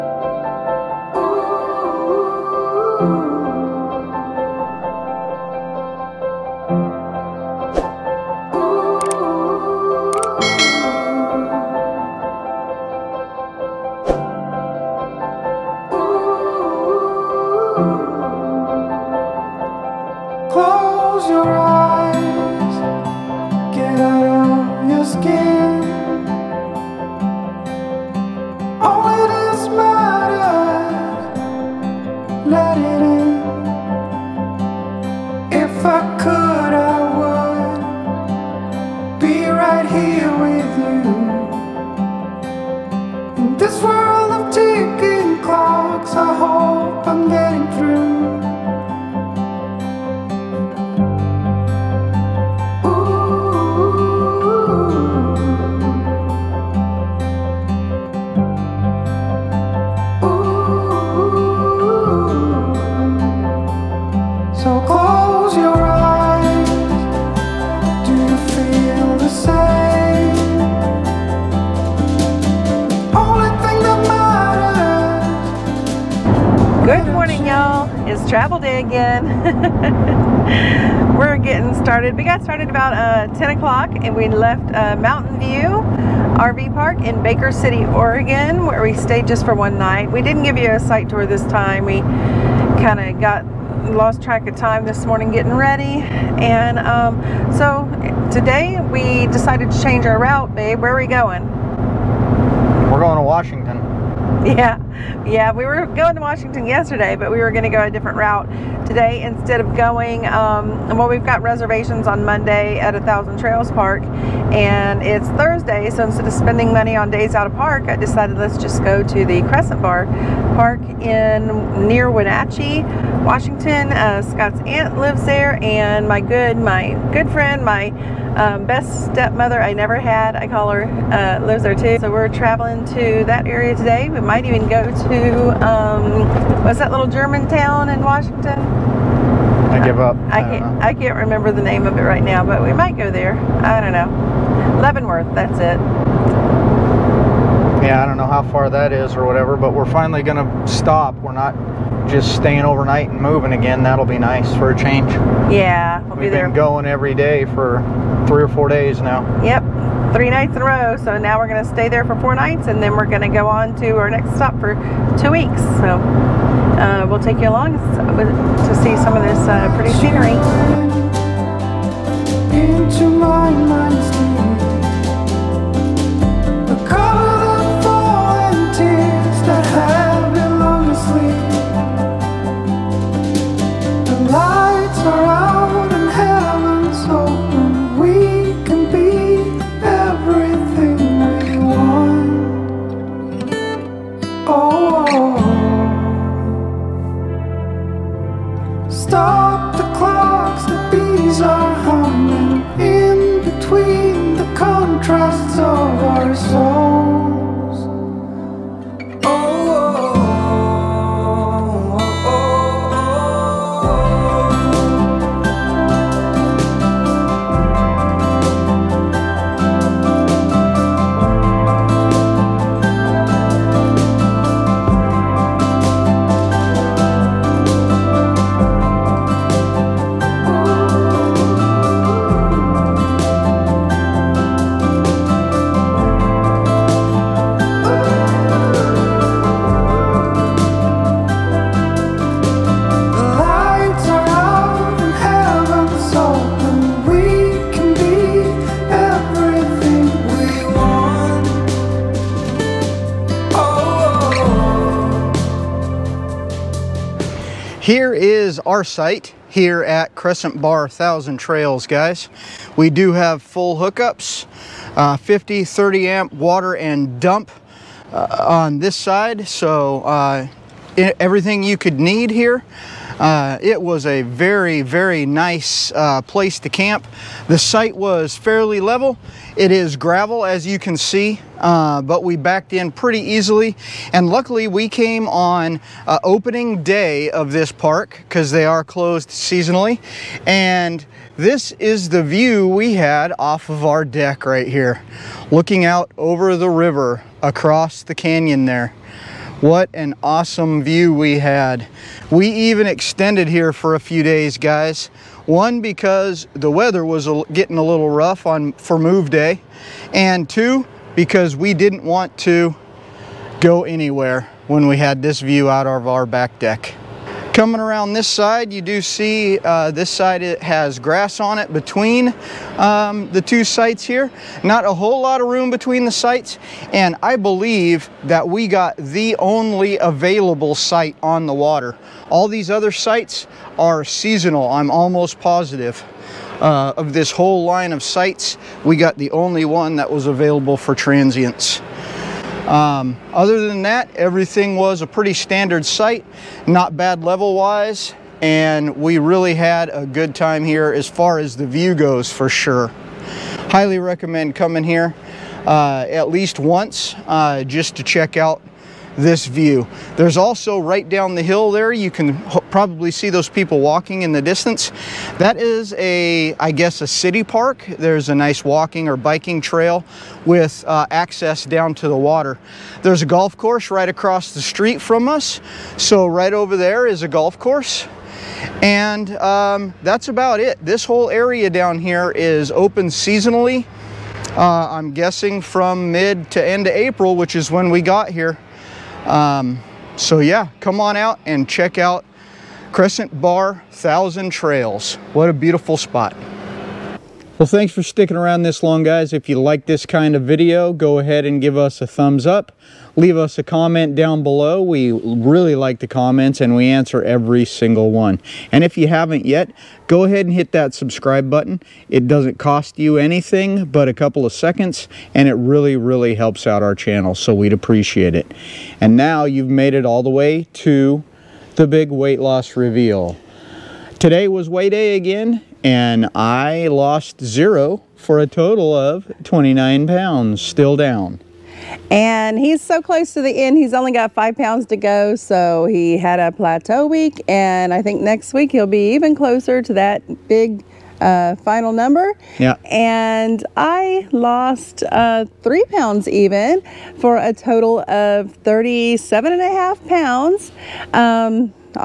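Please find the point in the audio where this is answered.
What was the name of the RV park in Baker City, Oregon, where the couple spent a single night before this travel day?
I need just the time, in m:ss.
1:24.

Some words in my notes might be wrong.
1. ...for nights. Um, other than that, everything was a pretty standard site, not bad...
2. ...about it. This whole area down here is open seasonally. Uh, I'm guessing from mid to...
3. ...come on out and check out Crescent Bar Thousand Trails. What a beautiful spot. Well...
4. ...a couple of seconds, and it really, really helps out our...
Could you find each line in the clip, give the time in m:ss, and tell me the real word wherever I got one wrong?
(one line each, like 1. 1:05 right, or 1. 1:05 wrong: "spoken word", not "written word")
1. 5:40 wrong: "transients", not "nights"
2. 6:20 right
3. 6:30 right
4. 6:54 right.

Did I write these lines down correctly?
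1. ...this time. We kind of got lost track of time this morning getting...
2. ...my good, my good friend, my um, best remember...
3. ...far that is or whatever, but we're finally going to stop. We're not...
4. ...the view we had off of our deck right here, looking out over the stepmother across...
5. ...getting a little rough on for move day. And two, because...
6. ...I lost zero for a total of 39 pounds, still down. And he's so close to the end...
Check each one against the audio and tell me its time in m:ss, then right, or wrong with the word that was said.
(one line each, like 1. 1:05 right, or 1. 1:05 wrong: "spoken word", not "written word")
1. 1:31 right
2. 2:06 wrong: "stepmother", not "remember"
3. 2:28 right
4. 4:52 wrong: "river", not "stepmother"
5. 5:07 right
6. 7:06 wrong: "29", not "39".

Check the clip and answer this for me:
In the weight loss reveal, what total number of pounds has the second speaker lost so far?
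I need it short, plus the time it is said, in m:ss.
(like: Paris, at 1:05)
37.5 pounds, at 7:28.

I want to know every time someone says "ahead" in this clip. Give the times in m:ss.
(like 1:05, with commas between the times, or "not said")
6:41, 6:50.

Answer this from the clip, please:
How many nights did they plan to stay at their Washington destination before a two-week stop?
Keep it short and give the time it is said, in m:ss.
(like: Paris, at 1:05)
4, at 2:42.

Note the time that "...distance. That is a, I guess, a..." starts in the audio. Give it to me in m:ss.
6:04.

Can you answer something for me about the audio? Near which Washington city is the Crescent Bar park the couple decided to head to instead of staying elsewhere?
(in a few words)
Wenatchee.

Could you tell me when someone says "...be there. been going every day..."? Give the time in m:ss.
2:36.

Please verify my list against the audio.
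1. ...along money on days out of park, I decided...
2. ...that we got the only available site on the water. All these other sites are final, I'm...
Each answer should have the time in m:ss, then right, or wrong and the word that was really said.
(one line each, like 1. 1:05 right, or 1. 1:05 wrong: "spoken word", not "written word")
1. 1:56 wrong: "spending", not "along"
2. 5:28 wrong: "seasonal", not "final".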